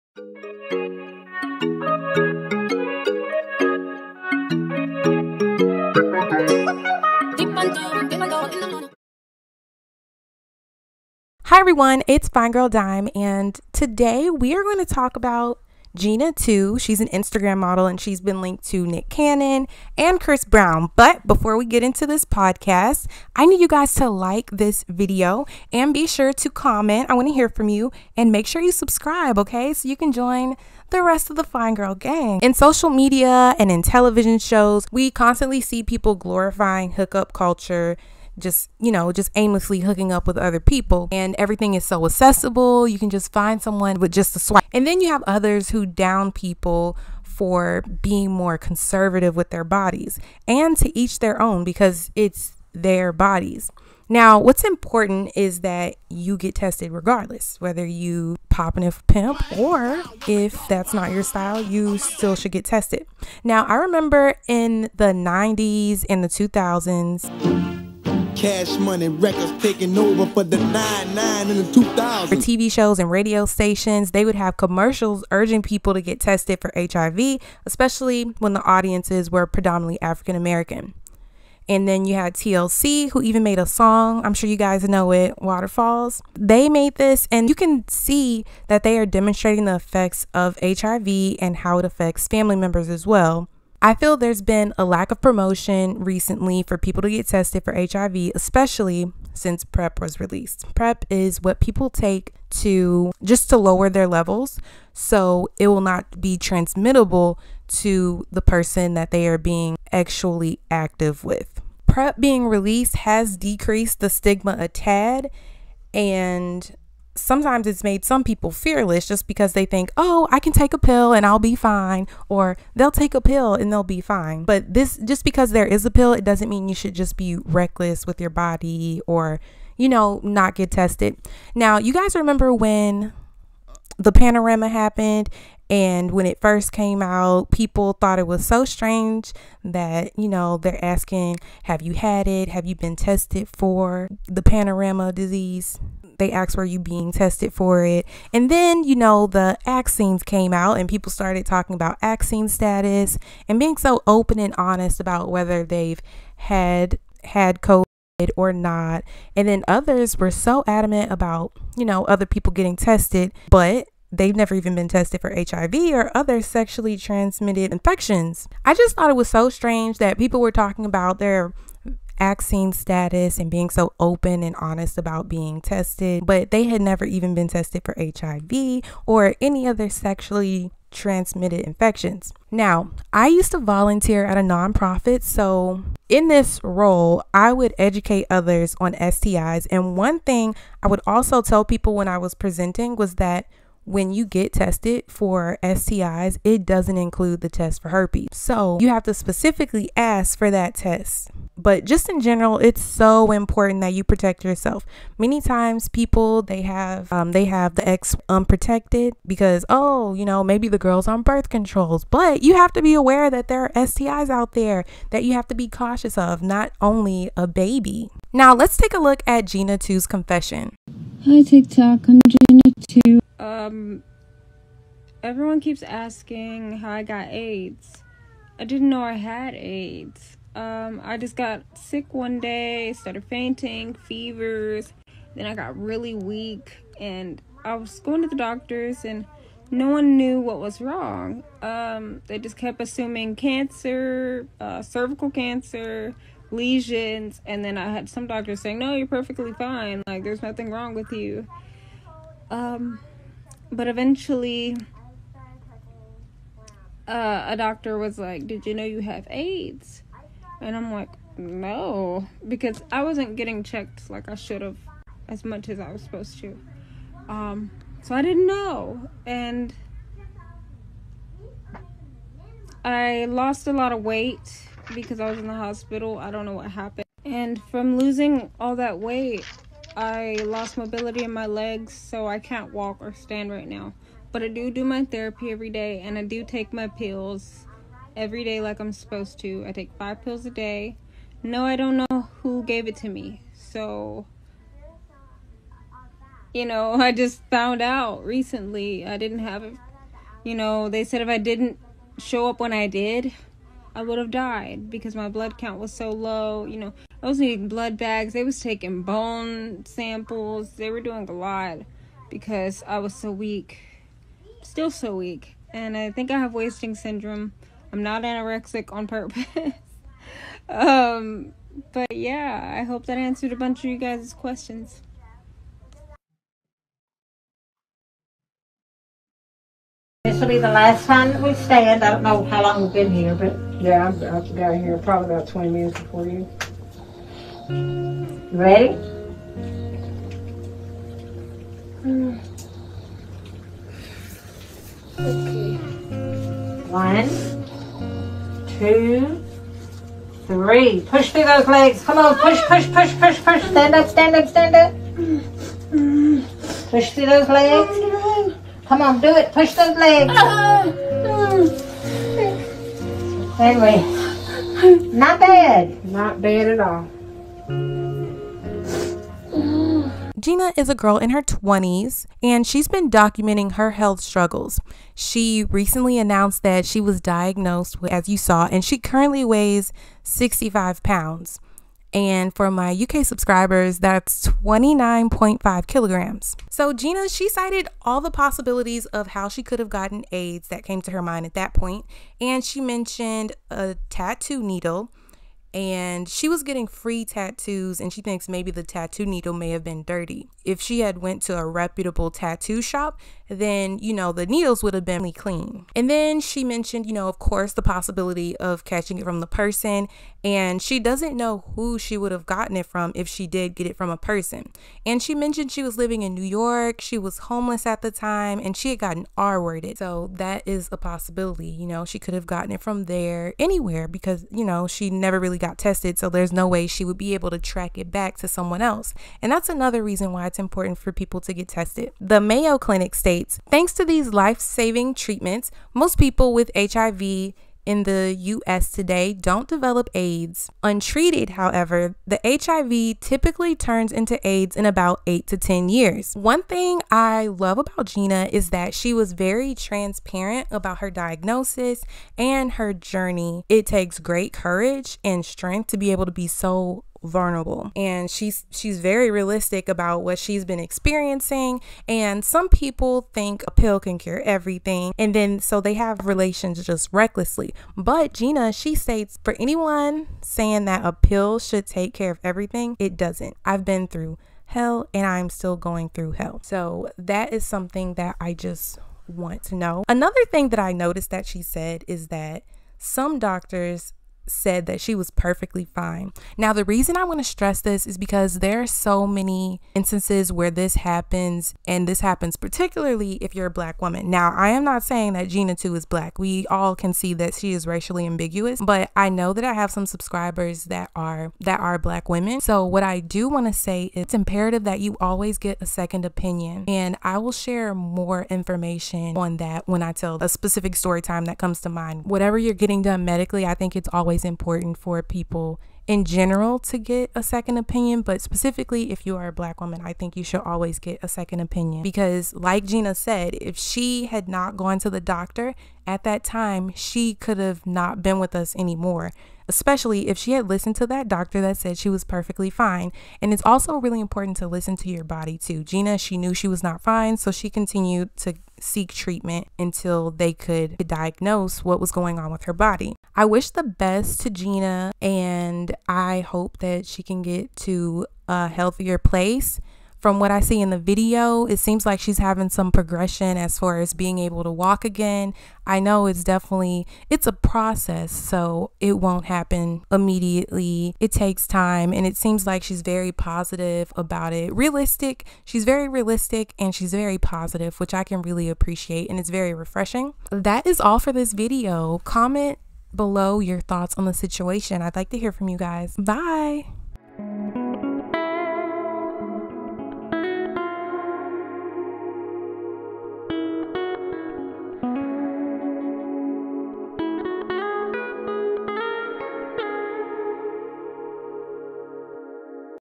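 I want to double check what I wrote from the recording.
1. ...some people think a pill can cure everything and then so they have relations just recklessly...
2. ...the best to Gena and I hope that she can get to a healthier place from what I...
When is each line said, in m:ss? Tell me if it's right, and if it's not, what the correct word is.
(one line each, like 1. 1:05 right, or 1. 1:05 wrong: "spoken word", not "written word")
1. 7:42 right
2. 9:03 right.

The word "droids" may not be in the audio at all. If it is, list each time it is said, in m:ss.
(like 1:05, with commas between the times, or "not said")
not said.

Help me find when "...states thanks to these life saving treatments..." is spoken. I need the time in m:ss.
7:13.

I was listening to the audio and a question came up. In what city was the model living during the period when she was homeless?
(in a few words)
New York.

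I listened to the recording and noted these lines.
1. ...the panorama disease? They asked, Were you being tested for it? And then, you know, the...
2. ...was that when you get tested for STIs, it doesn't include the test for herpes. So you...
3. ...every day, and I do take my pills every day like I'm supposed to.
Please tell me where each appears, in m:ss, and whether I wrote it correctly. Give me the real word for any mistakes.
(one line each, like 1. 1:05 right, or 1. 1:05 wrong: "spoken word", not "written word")
1. 2:24 right
2. 3:12 right
3. 4:45 right.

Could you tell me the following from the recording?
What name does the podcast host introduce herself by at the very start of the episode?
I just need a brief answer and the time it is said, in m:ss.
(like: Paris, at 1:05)
Fine Girl Dime, at 0:12.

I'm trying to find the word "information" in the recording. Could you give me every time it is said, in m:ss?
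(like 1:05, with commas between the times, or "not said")
8:28.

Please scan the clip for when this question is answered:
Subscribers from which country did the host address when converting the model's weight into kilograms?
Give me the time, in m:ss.
6:22.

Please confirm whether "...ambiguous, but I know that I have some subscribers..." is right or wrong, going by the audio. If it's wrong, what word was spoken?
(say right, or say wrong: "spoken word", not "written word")
right.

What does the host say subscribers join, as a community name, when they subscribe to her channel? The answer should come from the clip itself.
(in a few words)
the fine girl gang.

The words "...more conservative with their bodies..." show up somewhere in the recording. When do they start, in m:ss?
0:48.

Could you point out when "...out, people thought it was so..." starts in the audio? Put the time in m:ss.
2:17.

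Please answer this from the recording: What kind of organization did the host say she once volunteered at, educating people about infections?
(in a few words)
A nonprofit.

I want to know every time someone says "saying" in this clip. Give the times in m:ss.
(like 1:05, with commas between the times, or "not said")
4:08, 7:50, 8:15.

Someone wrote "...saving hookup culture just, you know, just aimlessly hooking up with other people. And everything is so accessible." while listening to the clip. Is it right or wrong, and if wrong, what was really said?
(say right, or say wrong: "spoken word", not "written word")
wrong: "glorifying", not "saving".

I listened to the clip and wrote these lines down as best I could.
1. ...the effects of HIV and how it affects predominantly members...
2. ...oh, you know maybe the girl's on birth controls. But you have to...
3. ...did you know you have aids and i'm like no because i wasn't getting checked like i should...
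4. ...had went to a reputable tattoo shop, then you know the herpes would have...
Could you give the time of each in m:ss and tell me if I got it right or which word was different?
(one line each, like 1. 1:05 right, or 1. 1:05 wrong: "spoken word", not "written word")
1. 1:29 wrong: "family", not "predominantly"
2. 3:29 right
3. 4:18 right
4. 6:40 wrong: "needles", not "herpes".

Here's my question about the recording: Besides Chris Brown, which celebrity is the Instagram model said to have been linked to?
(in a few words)
Nick Cannon.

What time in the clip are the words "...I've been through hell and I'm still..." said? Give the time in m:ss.
7:53.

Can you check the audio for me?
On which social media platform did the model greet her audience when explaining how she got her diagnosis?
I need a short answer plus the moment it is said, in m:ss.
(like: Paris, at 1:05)
TikTok, at 3:41.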